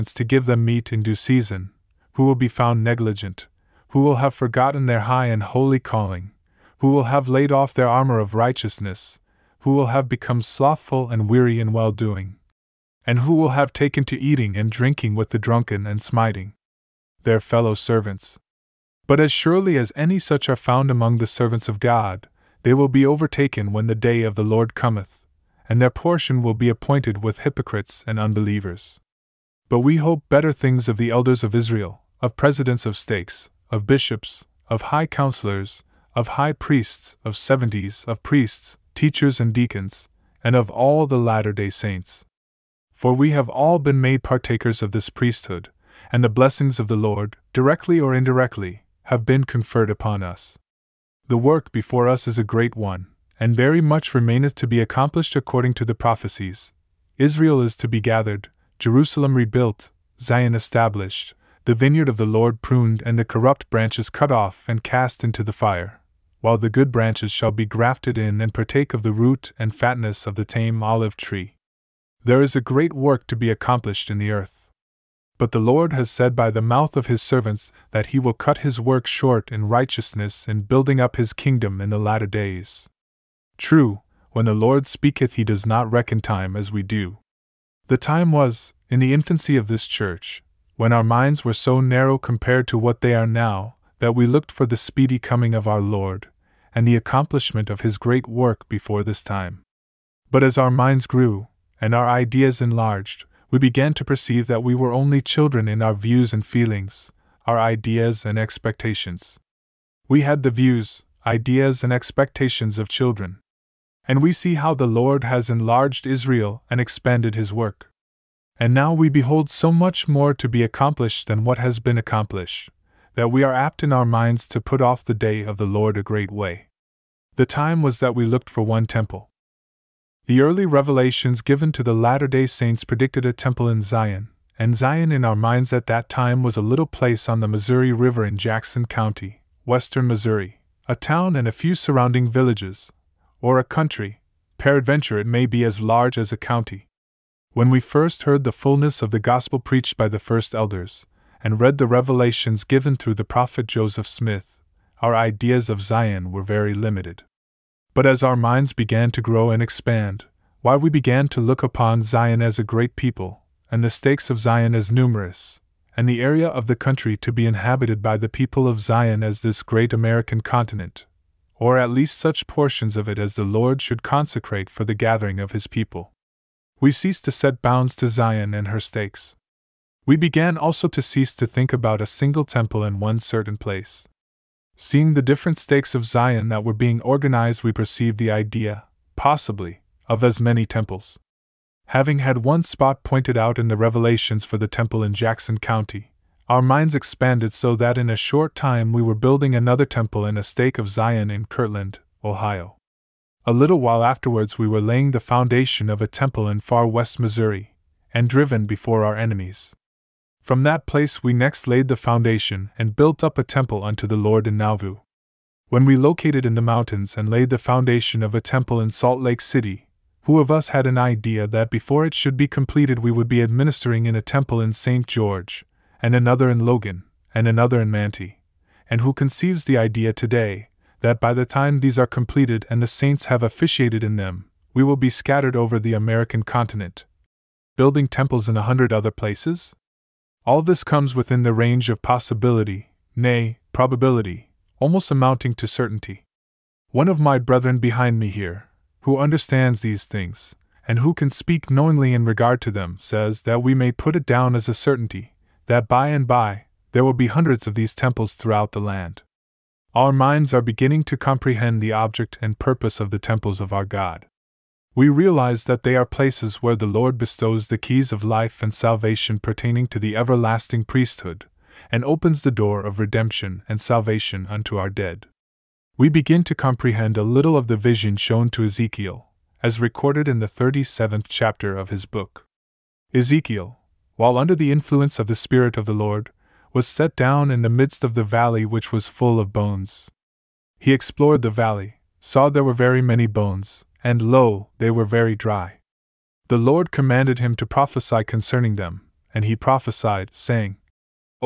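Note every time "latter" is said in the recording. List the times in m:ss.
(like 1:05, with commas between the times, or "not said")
0:41, 1:21, 2:11.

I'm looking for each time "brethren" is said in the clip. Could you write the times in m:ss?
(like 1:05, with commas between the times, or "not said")
4:07.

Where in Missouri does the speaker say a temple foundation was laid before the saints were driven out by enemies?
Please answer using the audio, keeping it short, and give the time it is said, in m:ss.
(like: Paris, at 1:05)
Far West, at 3:26.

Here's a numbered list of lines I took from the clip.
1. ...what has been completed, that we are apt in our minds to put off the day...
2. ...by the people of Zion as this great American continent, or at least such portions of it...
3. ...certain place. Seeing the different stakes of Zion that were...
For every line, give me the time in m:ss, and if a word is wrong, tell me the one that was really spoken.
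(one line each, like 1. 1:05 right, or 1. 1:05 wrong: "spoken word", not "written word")
1. 2:01 wrong: "accomplished", not "completed"
2. 2:48 right
3. 3:03 right.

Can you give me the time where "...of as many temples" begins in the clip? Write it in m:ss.
3:10.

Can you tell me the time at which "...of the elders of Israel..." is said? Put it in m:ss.
0:30.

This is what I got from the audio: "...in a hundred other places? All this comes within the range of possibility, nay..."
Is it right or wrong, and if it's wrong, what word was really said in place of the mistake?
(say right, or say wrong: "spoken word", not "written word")
right.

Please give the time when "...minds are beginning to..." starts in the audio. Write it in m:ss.
4:20.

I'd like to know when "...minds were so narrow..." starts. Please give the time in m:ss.
1:31.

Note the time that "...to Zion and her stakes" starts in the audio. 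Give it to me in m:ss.
2:57.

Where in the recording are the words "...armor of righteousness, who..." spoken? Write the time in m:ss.
0:07.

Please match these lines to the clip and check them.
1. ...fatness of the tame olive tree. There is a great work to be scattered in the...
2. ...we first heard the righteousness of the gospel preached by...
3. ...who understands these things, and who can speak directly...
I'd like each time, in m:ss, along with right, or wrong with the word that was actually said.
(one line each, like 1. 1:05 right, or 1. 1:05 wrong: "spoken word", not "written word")
1. 1:09 wrong: "accomplished", not "scattered"
2. 2:27 wrong: "fullness", not "righteousness"
3. 4:09 wrong: "knowingly", not "directly".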